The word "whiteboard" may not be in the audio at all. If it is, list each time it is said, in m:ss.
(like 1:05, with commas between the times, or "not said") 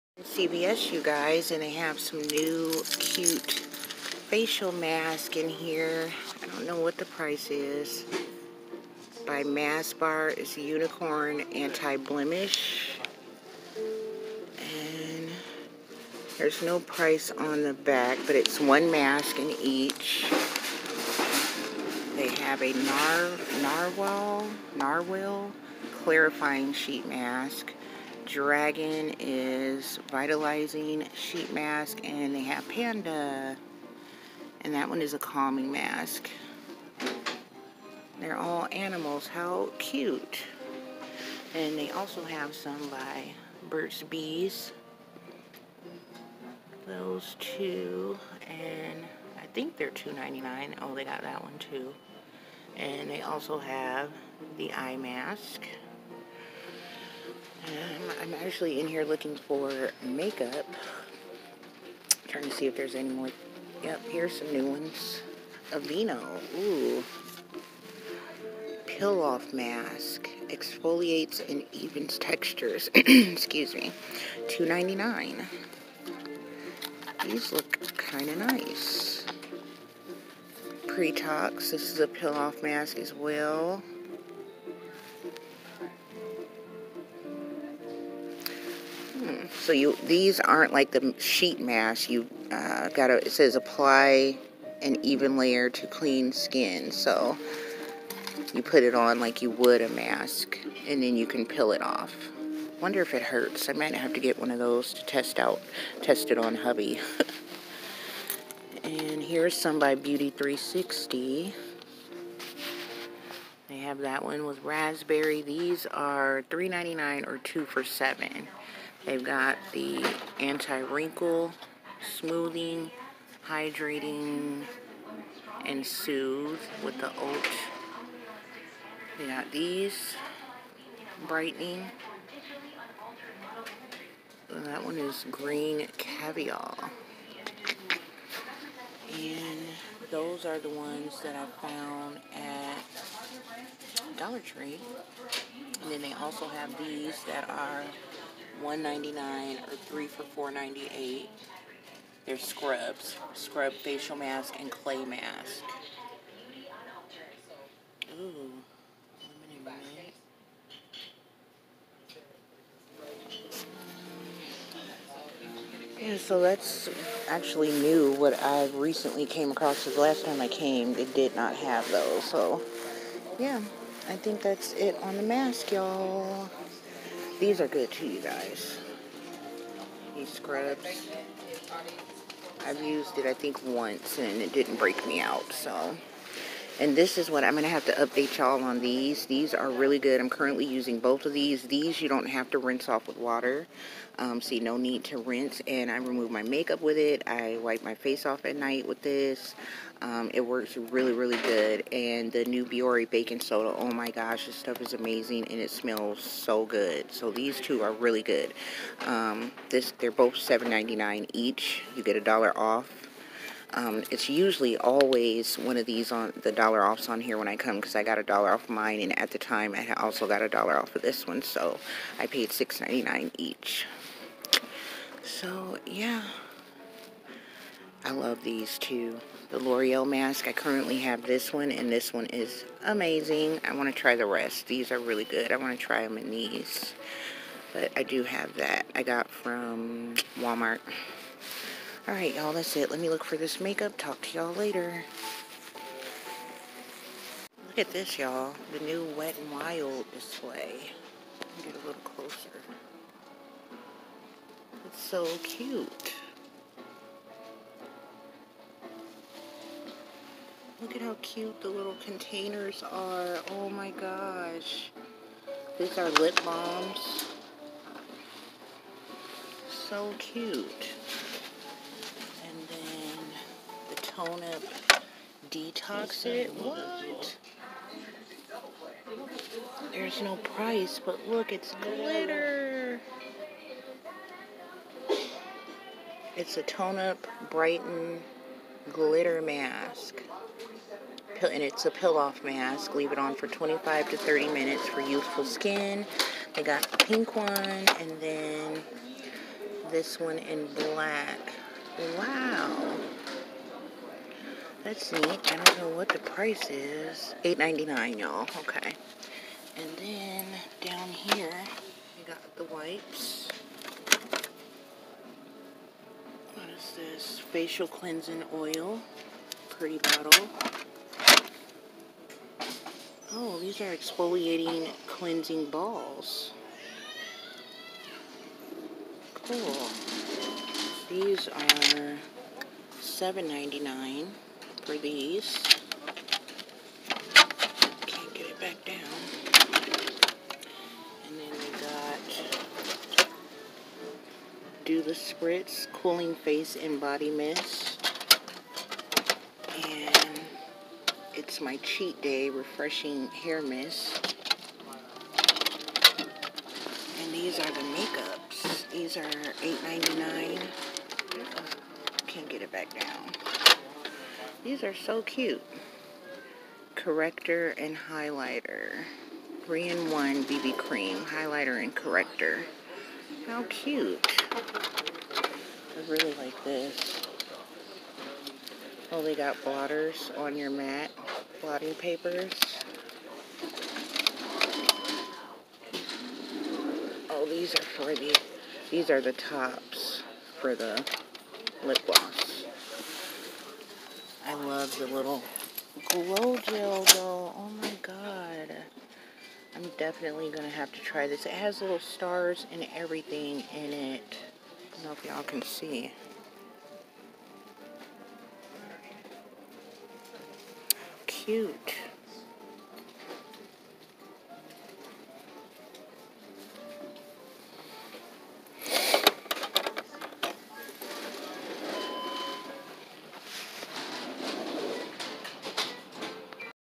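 not said.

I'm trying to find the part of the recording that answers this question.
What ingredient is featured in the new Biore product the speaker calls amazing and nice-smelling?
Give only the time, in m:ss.
3:23.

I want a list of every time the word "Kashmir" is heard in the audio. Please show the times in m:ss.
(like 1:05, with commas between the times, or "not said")
not said.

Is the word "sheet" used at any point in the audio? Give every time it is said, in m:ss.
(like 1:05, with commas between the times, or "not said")
0:26, 0:31, 1:31.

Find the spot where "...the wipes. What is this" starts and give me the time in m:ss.
5:12.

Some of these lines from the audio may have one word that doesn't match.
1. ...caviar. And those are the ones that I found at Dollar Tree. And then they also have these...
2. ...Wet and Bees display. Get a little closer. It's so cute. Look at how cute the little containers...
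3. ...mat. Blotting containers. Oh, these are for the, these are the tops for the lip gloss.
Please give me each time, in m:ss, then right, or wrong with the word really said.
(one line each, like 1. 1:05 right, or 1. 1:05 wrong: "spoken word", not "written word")
1. 2:15 right
2. 4:09 wrong: "Wild", not "Bees"
3. 6:20 wrong: "papers", not "containers".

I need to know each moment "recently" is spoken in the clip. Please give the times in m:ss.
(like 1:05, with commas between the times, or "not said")
2:48.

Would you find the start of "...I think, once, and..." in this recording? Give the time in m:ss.
3:03.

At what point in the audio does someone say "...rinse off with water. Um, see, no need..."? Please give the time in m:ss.
3:12.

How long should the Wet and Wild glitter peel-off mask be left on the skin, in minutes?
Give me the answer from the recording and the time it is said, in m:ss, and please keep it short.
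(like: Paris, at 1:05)
25 to 30 minutes, at 4:53.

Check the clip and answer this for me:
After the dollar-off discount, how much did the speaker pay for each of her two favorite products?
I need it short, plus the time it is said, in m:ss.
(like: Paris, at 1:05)
$6.99, at 3:42.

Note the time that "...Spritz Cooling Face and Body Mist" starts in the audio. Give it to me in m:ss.
5:45.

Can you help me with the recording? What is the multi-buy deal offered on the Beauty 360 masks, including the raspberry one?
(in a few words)
2 for $7.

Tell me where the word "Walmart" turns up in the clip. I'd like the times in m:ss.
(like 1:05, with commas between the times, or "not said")
4:00.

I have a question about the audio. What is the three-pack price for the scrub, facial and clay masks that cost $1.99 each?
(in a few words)
3 for $4.98.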